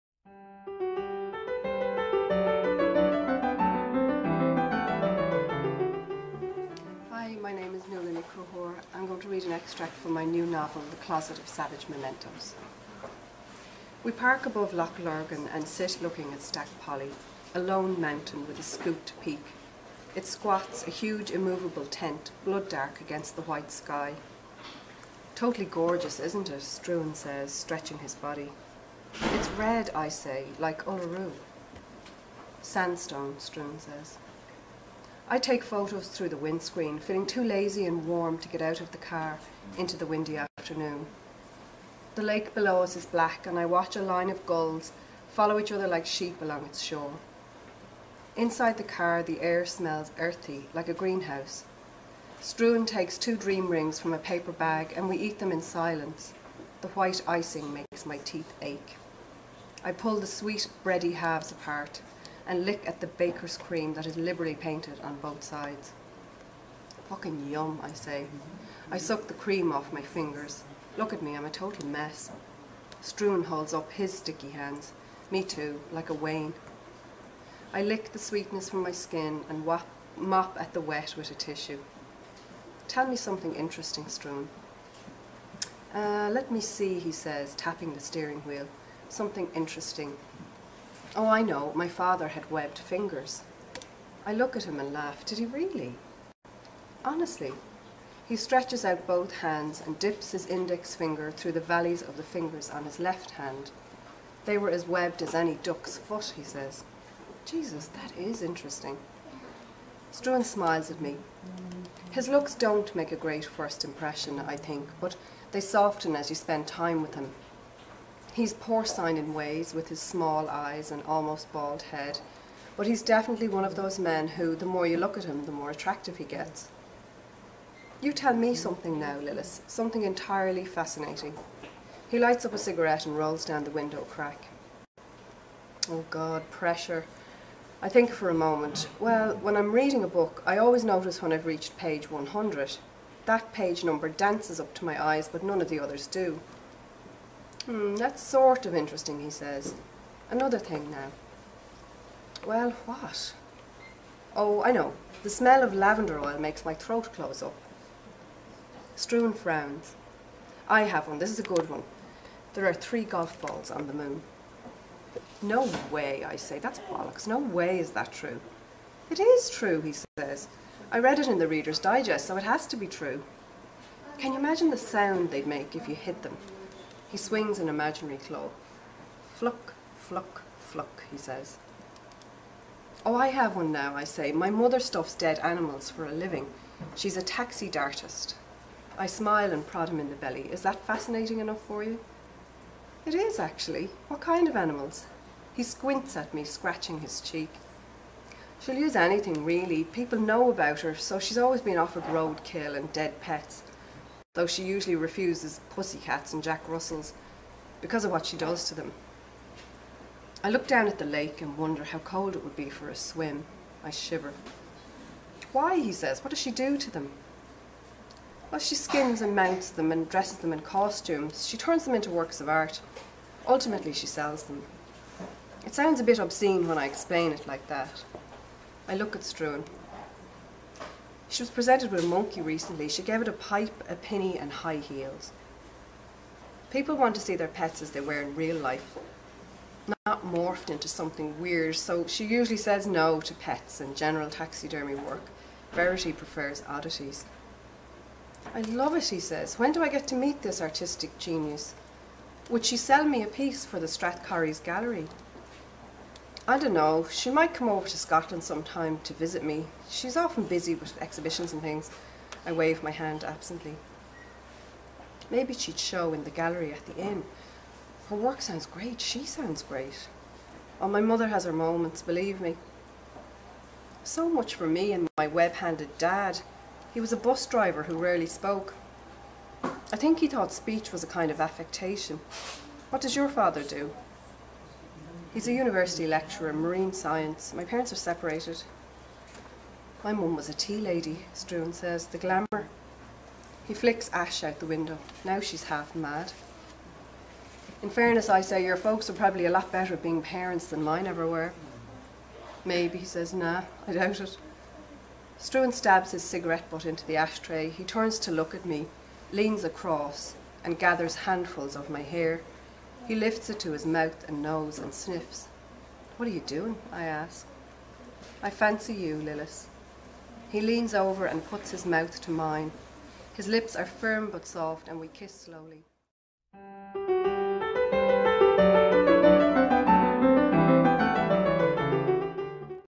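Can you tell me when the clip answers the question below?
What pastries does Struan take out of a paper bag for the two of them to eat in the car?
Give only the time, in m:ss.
0:53.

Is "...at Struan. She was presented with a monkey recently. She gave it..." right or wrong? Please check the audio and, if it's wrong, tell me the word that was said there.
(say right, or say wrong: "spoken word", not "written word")
right.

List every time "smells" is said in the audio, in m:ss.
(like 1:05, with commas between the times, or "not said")
0:49, 2:35.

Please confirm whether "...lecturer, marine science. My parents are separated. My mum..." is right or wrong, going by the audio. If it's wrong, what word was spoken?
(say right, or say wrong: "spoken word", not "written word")
right.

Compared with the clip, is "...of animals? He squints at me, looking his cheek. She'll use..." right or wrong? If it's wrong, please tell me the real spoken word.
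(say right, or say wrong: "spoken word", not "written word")
wrong: "scratching", not "looking".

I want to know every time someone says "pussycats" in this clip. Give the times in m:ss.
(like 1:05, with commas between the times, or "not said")
3:25.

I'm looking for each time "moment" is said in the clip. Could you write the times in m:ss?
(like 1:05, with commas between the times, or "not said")
2:18, 4:31.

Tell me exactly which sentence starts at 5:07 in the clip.
He turns to look at me, leans across, and gathers handfuls of my hair.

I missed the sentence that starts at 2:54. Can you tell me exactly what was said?
Can you imagine the sound they'd make if you hit them?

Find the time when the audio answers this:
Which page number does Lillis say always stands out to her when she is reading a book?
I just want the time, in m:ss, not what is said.
2:21.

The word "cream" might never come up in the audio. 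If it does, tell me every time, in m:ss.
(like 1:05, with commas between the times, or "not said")
1:03, 1:09.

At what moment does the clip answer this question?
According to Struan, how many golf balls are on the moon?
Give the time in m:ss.
2:42.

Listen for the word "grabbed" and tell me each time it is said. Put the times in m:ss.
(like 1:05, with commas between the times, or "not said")
not said.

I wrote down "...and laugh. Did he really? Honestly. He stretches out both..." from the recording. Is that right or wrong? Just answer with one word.
right.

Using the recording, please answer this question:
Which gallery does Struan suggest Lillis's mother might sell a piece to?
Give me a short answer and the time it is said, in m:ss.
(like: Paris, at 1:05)
Strathcorries Gallery, at 4:13.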